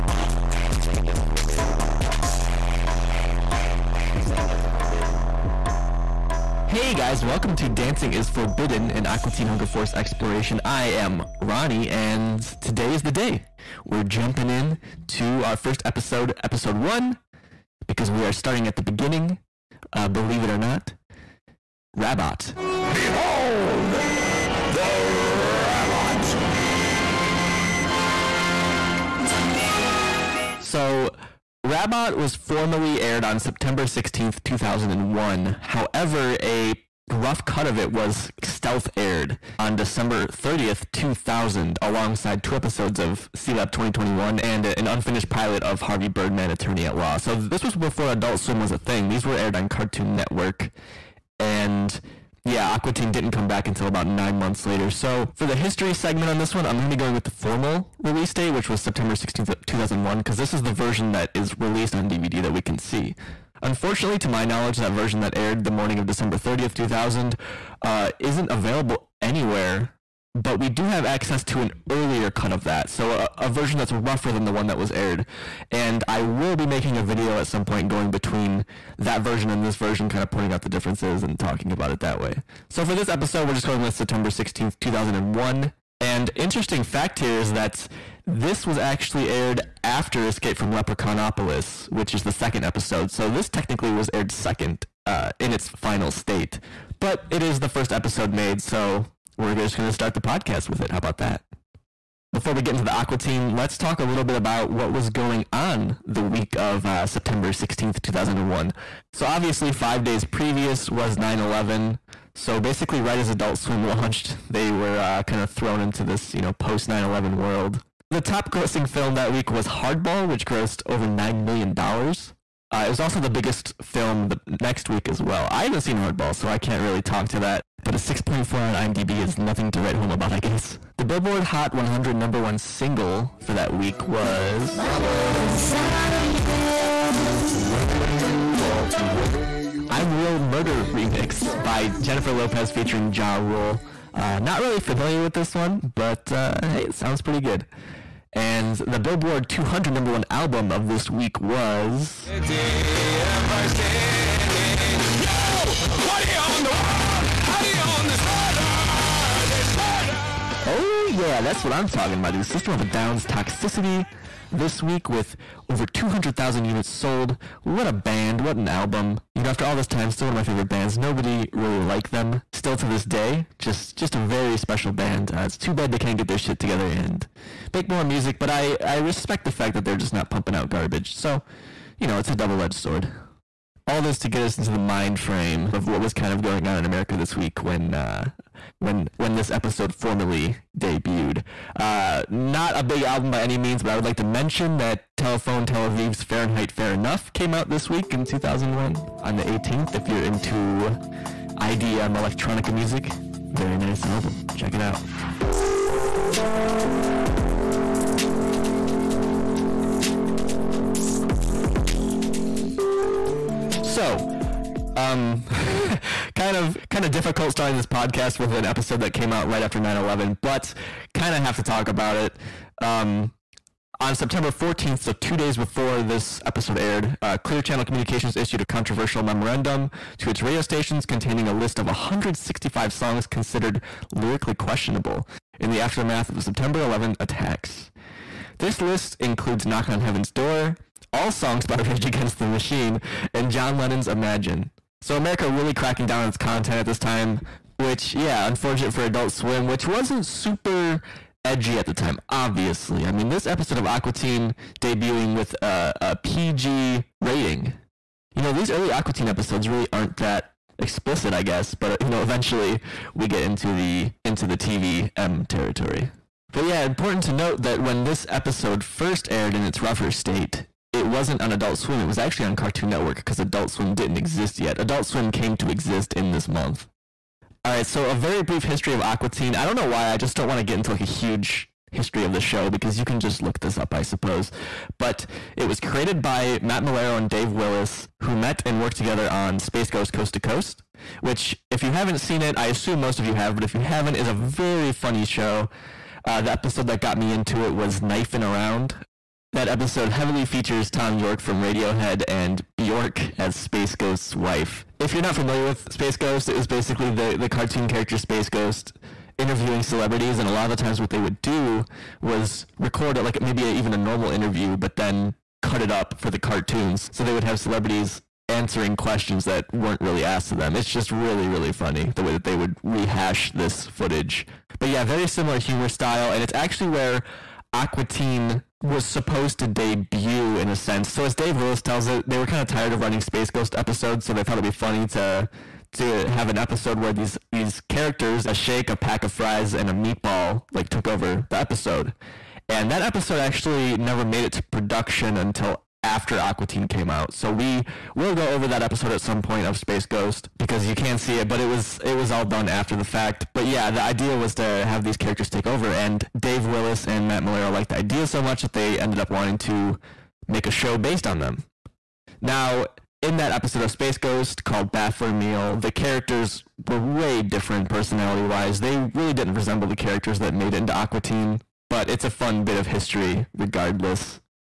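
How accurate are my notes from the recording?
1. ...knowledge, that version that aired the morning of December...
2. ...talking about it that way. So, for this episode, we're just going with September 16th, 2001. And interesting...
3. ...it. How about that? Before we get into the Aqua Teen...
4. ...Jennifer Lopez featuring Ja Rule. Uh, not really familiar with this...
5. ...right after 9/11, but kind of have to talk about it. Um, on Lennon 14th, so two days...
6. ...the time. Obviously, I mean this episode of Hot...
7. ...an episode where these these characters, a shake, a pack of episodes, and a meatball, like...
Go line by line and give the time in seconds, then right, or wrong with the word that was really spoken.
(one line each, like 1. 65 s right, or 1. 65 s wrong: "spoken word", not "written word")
1. 64 s right
2. 81 s right
3. 100 s right
4. 142 s right
5. 219 s wrong: "September", not "Lennon"
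6. 251 s wrong: "Aqua", not "Hot"
7. 336 s wrong: "fries", not "episodes".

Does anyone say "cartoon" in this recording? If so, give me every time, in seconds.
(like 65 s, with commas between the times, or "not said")
49 s, 272 s, 307 s, 316 s.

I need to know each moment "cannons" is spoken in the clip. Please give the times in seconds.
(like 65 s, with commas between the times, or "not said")
not said.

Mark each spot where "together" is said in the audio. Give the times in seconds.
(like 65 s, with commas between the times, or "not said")
176 s, 288 s.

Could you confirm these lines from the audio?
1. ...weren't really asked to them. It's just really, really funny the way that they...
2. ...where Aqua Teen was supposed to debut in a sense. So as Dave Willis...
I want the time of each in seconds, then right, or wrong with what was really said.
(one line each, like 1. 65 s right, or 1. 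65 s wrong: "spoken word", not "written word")
1. 319 s right
2. 326 s right.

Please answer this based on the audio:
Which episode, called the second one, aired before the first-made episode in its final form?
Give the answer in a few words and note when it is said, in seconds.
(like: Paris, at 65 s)
Escape from Leprechaunopolis, at 90 s.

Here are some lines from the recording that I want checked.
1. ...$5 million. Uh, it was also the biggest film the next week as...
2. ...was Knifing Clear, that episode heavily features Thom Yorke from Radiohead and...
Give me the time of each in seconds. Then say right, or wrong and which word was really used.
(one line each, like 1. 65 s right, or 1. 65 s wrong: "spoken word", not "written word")
1. 121 s wrong: "9", not "5"
2. 297 s wrong: "Around", not "Clear".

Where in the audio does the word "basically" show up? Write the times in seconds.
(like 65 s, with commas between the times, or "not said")
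112 s, 306 s.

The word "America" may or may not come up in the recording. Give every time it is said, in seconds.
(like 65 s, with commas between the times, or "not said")
186 s, 245 s.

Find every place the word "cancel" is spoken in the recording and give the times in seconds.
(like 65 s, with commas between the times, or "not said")
not said.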